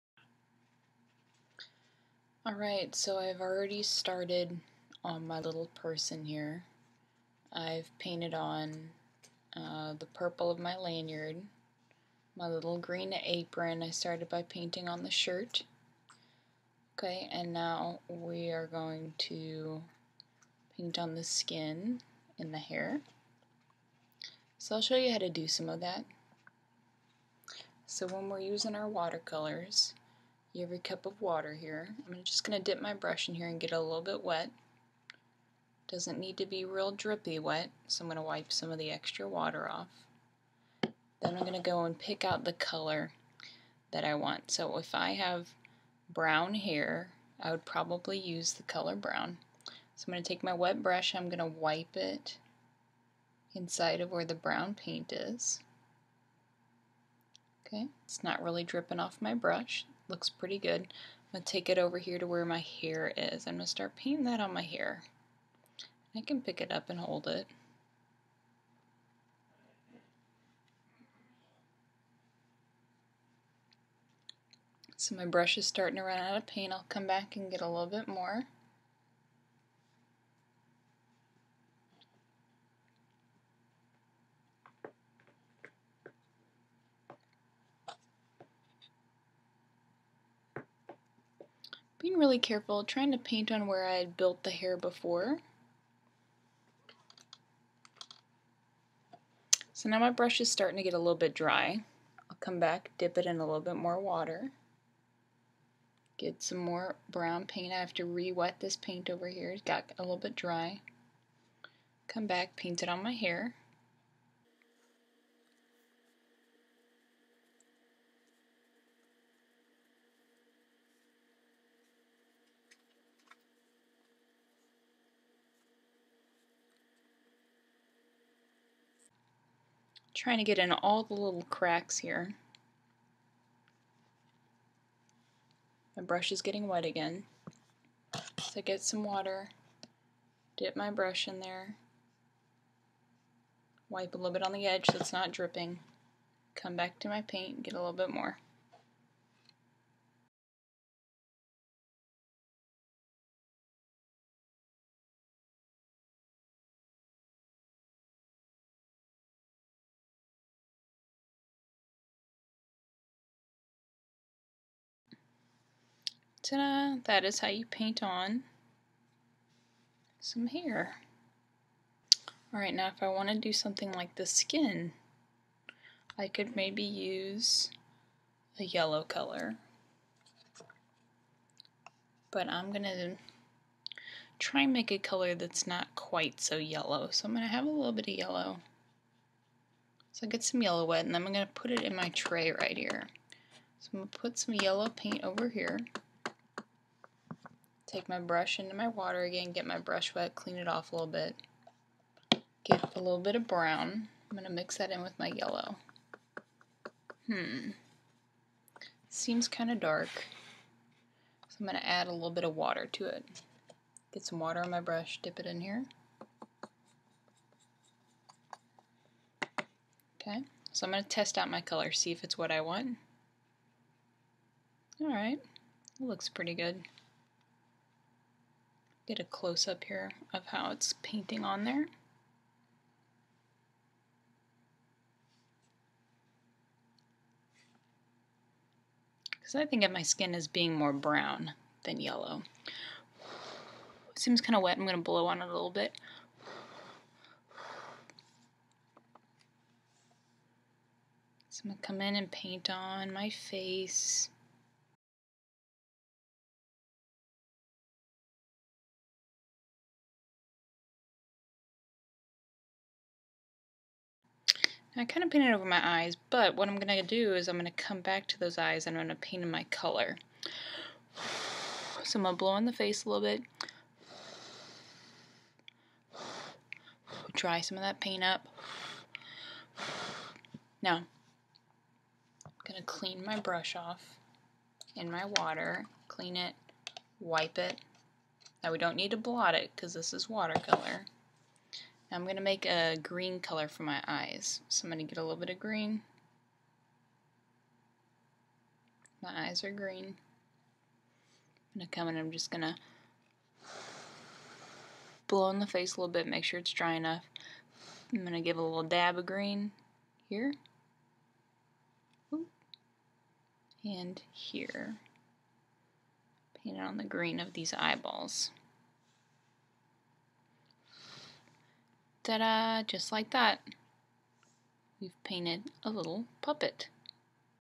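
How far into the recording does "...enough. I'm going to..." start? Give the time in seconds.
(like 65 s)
306 s.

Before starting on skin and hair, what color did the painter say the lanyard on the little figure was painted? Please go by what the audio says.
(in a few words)
purple.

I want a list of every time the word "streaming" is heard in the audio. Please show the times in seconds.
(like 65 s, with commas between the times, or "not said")
not said.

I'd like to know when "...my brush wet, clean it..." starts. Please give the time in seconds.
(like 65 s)
199 s.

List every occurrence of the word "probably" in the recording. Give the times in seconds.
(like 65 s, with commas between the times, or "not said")
47 s.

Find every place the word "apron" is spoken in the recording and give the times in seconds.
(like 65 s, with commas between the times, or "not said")
13 s.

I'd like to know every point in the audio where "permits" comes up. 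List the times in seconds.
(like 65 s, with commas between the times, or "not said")
not said.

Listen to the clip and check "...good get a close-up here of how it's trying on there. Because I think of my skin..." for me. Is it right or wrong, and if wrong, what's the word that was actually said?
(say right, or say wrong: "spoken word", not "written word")
wrong: "painting", not "trying".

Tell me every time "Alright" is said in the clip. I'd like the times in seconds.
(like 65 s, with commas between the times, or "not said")
2 s, 172 s, 225 s.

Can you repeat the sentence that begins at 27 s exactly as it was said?
So when we're using our watercolors, every cup of water here.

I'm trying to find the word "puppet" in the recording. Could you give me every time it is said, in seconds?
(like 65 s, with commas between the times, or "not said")
326 s.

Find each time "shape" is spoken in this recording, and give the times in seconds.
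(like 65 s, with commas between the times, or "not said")
not said.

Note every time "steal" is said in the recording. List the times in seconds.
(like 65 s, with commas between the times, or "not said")
not said.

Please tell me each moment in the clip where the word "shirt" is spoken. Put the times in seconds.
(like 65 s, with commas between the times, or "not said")
15 s.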